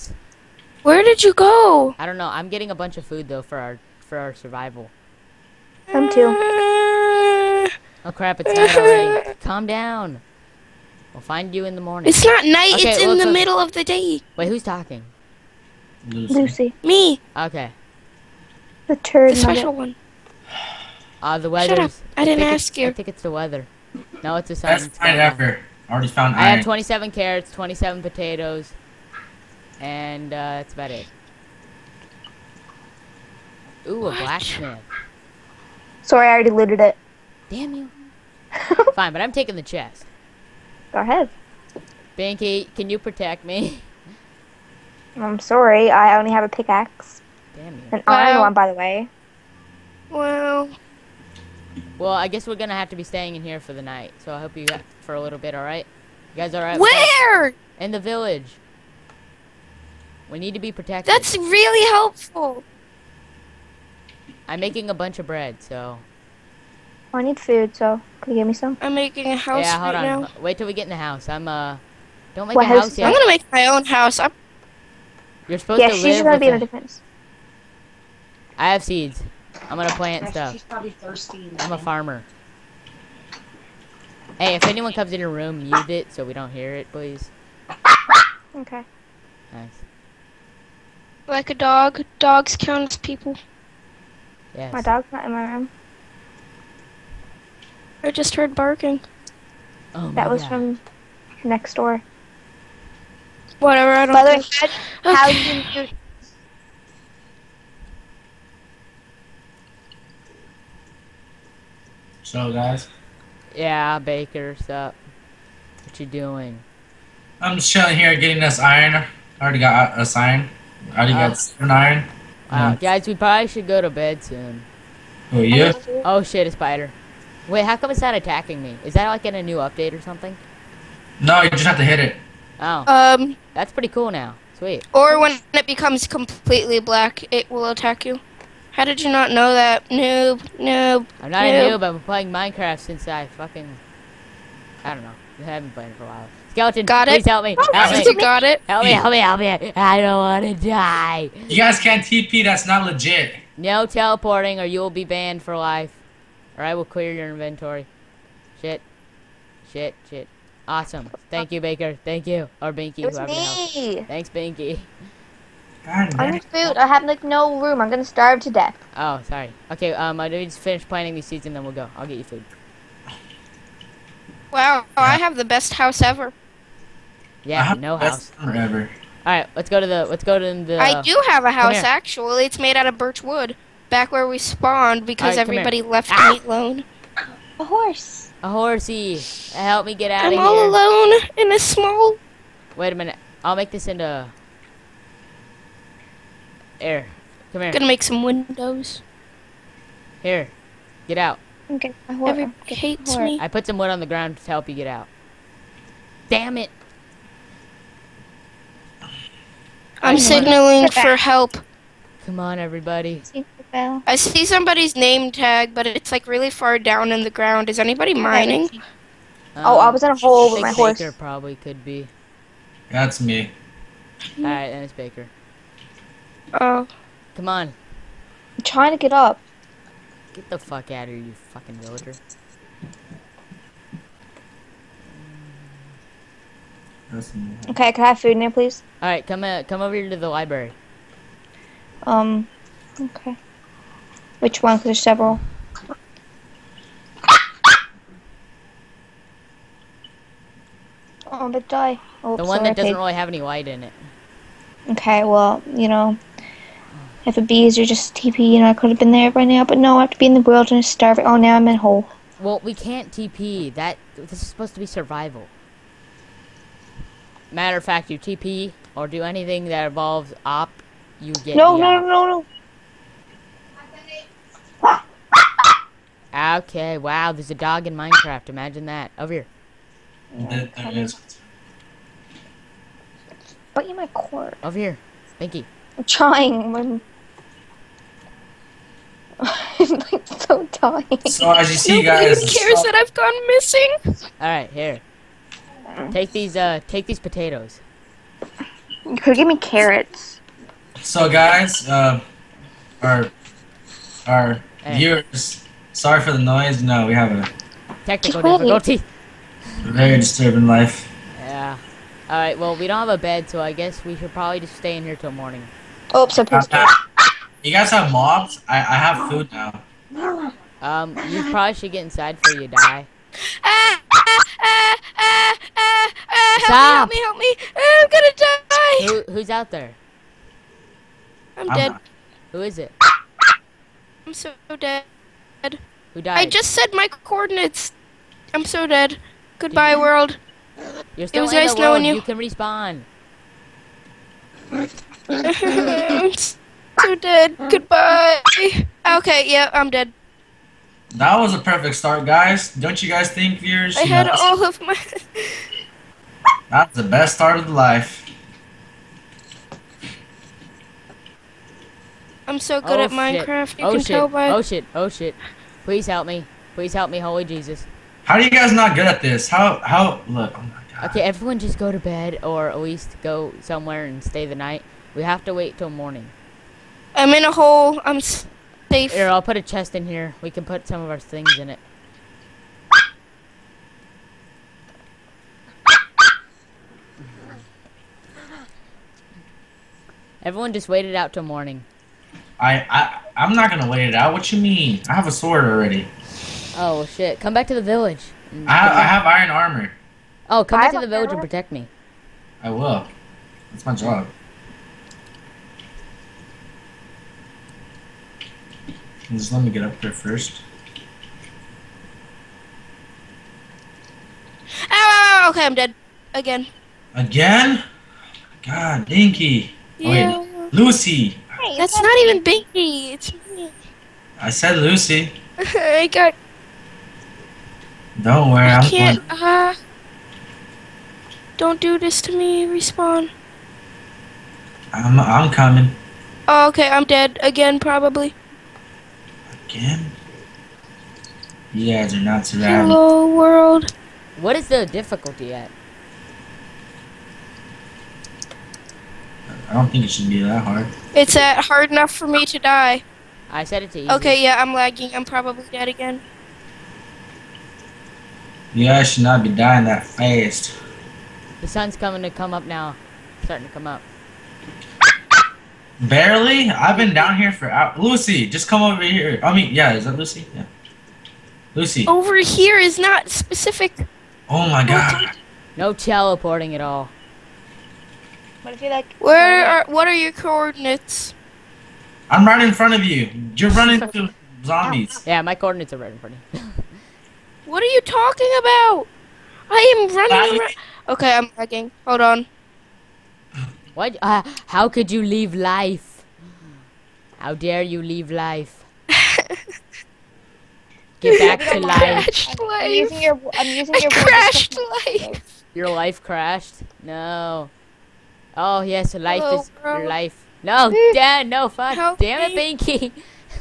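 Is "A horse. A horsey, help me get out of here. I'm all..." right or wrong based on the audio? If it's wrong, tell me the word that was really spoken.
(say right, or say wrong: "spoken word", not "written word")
right.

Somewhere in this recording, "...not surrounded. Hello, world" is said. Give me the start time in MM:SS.
07:22.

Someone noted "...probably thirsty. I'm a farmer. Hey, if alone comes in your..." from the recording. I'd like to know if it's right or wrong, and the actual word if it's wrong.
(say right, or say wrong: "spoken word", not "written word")
wrong: "anyone", not "alone".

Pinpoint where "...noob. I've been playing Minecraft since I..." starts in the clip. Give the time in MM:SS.
02:21.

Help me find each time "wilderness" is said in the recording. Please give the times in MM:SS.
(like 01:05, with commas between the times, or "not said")
04:20.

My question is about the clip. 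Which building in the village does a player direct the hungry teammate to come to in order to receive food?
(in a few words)
the library.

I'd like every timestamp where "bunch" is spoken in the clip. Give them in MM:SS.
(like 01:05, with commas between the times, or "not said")
00:02, 01:04.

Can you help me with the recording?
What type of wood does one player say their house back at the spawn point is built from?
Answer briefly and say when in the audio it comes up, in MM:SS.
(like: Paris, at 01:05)
birch wood, at 03:02.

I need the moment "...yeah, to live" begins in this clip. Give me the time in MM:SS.
01:15.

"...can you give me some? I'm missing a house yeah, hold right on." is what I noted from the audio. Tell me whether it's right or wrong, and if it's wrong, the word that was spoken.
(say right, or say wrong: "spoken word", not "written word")
wrong: "making", not "missing".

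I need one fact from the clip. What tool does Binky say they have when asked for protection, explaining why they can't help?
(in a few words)
pickaxe.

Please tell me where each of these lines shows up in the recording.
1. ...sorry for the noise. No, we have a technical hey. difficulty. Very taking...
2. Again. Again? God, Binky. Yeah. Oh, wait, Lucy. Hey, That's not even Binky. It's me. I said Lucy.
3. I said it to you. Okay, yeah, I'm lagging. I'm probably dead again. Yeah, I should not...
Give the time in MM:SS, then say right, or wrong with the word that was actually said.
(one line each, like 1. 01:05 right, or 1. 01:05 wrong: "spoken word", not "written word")
1. 05:05 wrong: "disturbing", not "taking"
2. 06:56 right
3. 07:33 right.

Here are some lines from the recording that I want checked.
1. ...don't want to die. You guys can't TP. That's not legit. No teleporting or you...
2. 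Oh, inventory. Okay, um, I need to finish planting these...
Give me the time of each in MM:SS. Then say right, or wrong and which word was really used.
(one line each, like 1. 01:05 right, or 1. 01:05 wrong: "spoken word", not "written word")
1. 02:30 right
2. 02:48 wrong: "sorry", not "inventory".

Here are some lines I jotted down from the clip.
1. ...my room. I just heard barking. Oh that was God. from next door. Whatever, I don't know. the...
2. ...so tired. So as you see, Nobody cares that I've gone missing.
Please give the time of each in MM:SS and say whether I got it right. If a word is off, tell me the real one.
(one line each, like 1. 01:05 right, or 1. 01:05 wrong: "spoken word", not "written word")
1. 01:35 right
2. 04:50 right.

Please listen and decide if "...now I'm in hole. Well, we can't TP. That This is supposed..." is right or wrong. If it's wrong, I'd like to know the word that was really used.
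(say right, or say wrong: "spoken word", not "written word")
right.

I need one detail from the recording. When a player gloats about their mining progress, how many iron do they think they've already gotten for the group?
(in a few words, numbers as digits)
seven.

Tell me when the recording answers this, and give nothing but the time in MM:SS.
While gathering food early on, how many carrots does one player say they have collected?
00:26.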